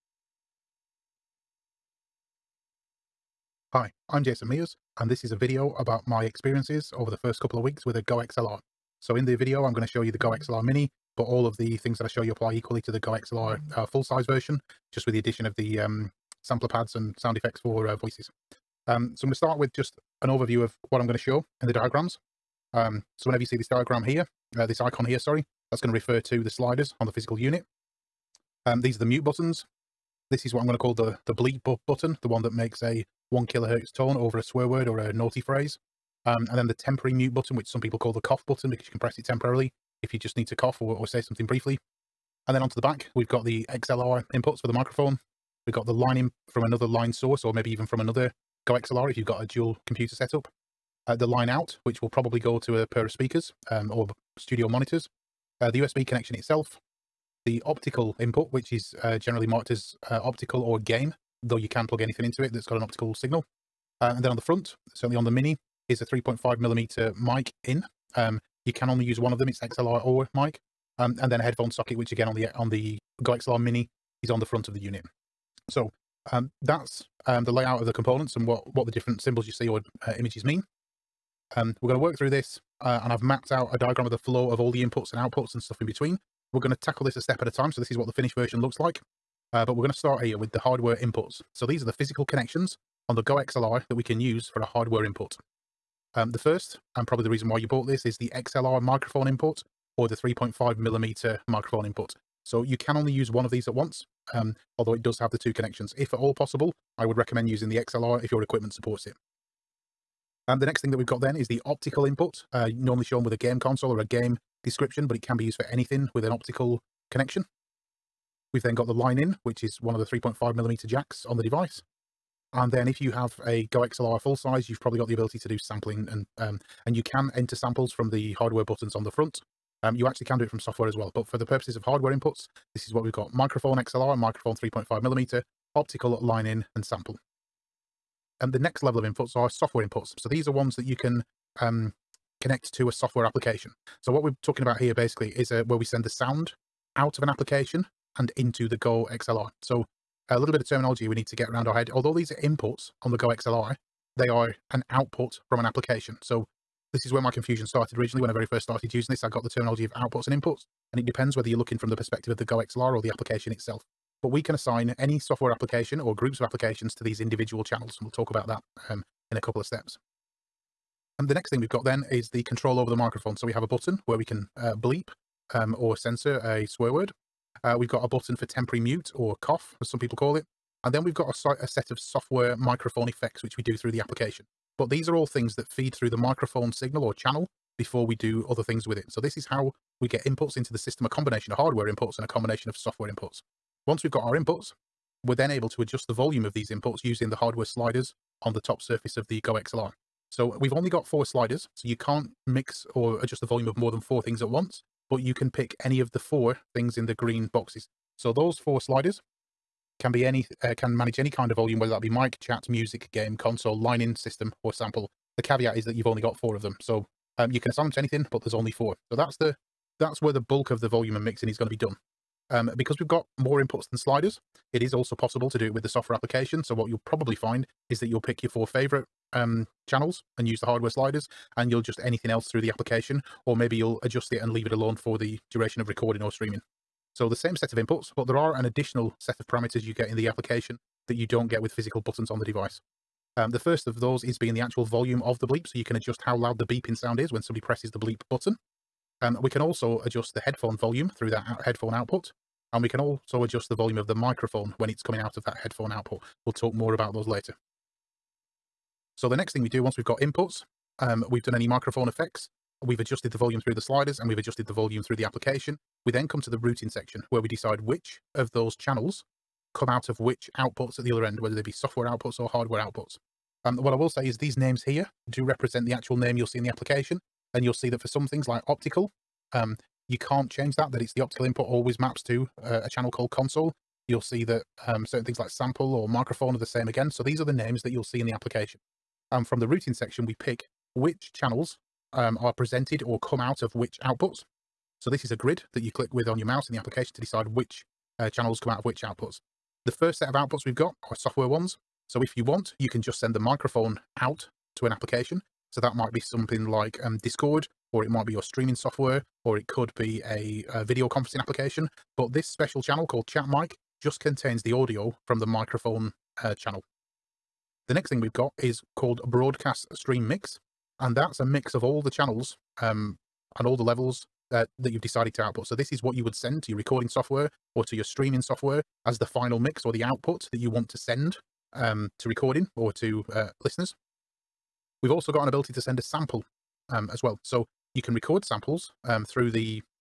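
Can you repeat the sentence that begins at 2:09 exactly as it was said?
Um, you actually can do it from software as well, but for the purposes of hardware inputs, this is what we've got.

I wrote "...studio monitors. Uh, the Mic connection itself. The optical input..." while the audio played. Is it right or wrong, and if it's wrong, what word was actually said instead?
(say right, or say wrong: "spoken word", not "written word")
wrong: "USB", not "Mic".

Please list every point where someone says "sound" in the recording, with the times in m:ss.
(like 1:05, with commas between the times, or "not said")
0:17, 2:26, 4:06.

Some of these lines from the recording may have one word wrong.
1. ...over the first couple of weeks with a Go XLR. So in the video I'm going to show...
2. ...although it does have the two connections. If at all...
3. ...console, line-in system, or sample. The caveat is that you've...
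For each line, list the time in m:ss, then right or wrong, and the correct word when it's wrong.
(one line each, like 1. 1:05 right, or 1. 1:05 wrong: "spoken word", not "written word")
1. 0:06 right
2. 1:44 right
3. 3:33 right.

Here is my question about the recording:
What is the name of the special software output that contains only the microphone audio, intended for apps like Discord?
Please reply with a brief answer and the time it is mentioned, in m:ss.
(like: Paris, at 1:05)
Chat Mic, at 5:13.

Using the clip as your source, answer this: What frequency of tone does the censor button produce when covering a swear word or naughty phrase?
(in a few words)
1 kilohertz.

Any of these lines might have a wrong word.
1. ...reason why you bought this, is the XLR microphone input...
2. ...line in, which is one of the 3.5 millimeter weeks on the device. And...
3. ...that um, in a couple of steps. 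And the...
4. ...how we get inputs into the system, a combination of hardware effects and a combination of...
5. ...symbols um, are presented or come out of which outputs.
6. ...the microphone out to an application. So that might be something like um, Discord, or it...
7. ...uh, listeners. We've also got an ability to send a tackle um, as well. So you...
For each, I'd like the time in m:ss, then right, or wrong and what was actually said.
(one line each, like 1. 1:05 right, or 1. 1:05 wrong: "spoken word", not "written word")
1. 1:37 right
2. 1:58 wrong: "jacks", not "weeks"
3. 2:48 right
4. 3:09 wrong: "inputs", not "effects"
5. 4:51 wrong: "channels", not "symbols"
6. 5:03 right
7. 5:33 wrong: "sample", not "tackle".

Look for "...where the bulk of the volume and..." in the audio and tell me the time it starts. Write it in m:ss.
3:40.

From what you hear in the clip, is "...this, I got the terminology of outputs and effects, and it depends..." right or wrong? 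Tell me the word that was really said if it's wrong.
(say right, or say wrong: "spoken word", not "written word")
wrong: "inputs", not "effects".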